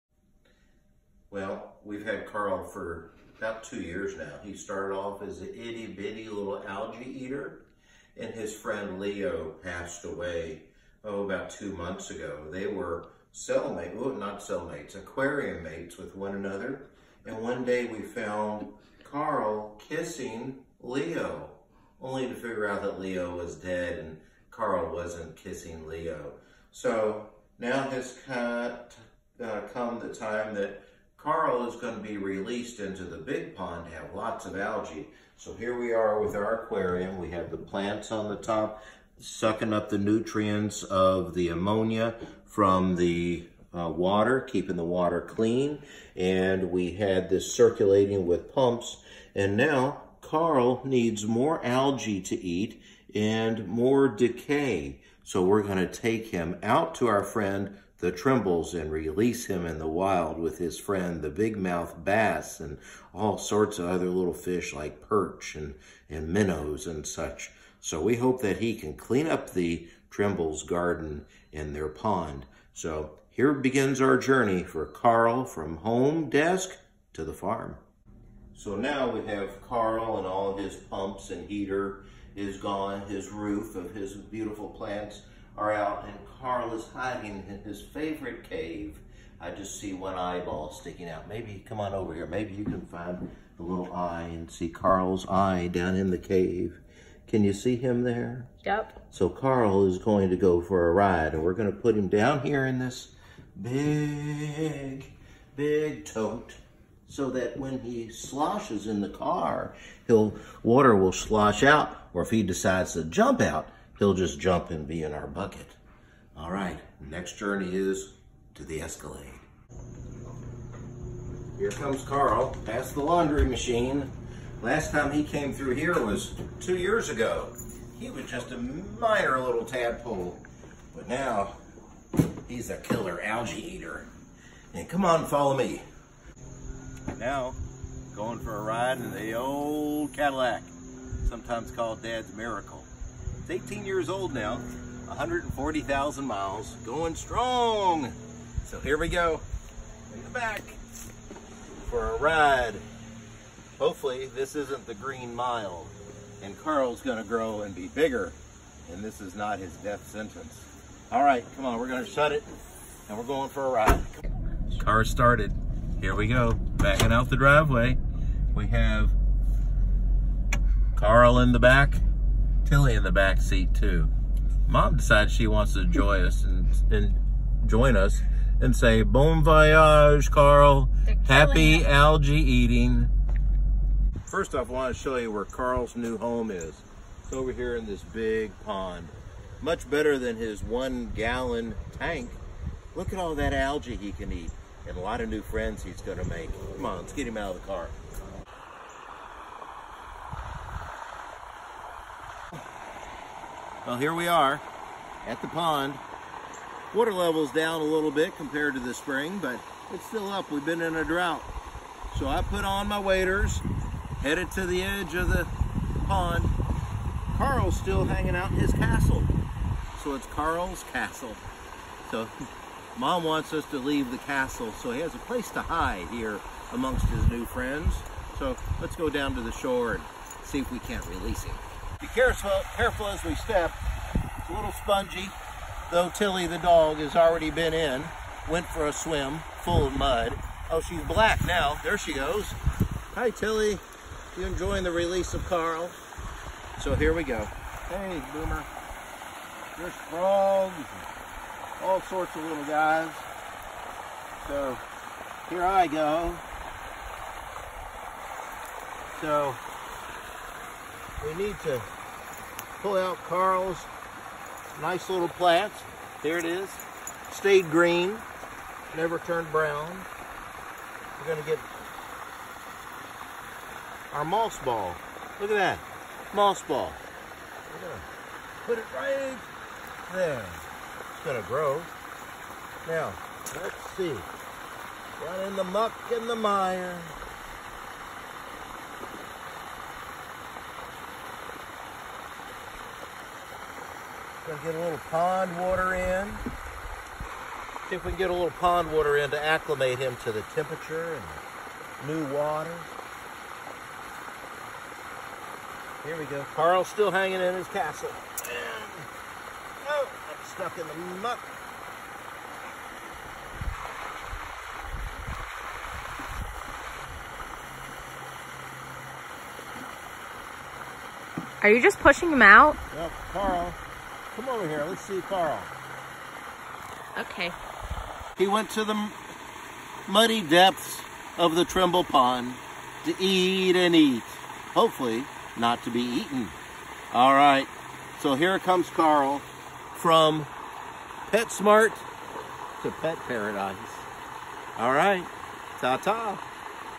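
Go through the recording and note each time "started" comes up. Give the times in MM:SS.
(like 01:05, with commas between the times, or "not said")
00:04, 02:45.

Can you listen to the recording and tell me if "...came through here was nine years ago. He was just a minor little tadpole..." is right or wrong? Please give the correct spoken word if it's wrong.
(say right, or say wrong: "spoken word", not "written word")
wrong: "two", not "nine".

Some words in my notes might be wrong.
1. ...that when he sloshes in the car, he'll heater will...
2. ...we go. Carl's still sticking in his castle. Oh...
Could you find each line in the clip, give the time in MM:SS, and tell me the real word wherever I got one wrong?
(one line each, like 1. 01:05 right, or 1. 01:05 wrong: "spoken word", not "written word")
1. 01:47 wrong: "water", not "heater"
2. 05:06 wrong: "hanging", not "sticking".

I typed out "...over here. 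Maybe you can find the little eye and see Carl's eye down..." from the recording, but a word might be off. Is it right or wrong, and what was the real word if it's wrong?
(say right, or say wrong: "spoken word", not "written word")
right.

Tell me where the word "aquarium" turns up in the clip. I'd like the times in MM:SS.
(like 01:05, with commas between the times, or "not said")
00:14, 00:36.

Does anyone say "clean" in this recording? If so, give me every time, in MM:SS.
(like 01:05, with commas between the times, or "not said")
00:45, 01:08.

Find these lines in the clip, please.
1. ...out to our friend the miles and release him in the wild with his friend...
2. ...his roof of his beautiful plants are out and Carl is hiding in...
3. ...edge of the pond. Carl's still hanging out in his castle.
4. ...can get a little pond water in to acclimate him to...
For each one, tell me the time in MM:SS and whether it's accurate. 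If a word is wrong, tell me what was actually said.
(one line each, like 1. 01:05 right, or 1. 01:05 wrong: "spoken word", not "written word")
1. 00:56 wrong: "trembles", not "miles"
2. 01:23 right
3. 03:34 right
4. 04:58 right.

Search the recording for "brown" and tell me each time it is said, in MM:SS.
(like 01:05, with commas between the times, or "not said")
04:29.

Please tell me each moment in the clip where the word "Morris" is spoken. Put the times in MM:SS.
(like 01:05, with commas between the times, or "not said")
not said.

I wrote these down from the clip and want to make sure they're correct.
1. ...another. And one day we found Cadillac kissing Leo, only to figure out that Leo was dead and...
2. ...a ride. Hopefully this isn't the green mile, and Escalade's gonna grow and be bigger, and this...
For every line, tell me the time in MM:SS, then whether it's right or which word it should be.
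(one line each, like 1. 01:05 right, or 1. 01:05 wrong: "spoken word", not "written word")
1. 00:16 wrong: "Carl", not "Cadillac"
2. 02:32 wrong: "Carl", not "Escalade".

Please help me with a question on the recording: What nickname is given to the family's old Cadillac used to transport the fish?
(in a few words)
Dad's Miracle.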